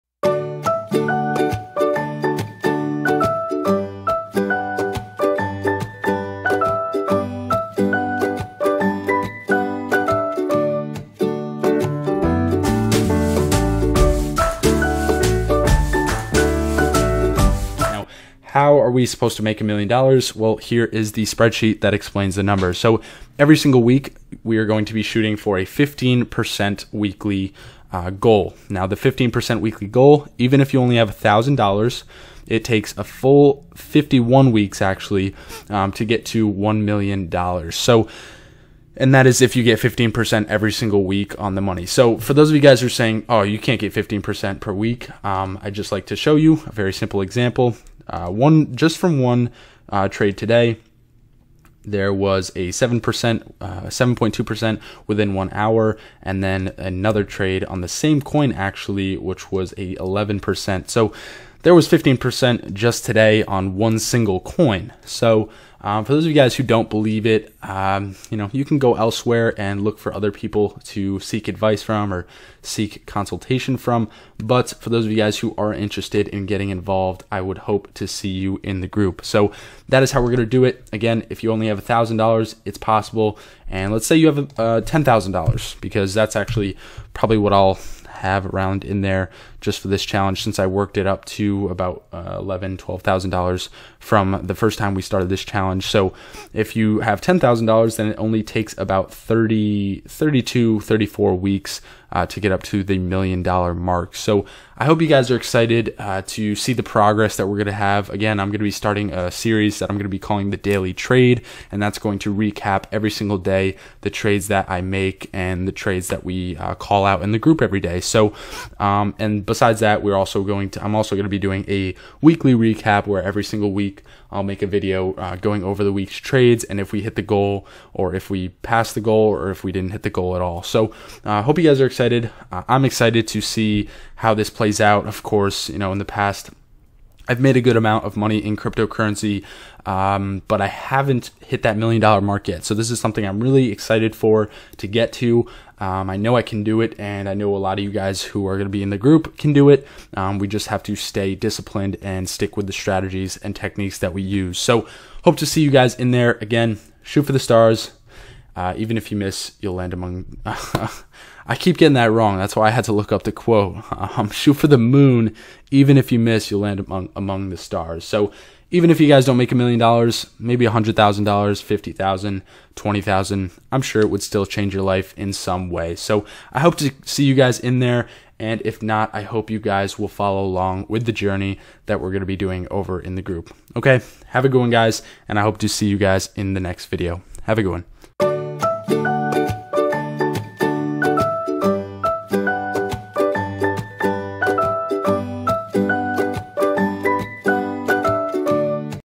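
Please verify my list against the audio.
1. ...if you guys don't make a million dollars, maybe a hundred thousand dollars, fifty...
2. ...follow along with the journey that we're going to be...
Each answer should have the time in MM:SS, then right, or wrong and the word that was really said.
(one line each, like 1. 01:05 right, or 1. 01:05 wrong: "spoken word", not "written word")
1. 02:48 right
2. 03:00 right.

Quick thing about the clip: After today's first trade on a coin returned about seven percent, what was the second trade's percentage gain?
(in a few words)
11%.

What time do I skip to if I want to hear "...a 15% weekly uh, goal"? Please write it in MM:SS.
00:25.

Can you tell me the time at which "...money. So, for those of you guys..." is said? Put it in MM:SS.
00:41.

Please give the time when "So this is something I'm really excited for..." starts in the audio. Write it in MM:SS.
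02:22.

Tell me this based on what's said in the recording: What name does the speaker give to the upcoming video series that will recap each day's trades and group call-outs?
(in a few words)
the Daily Trade.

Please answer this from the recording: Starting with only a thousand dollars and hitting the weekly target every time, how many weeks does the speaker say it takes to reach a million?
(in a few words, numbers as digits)
51.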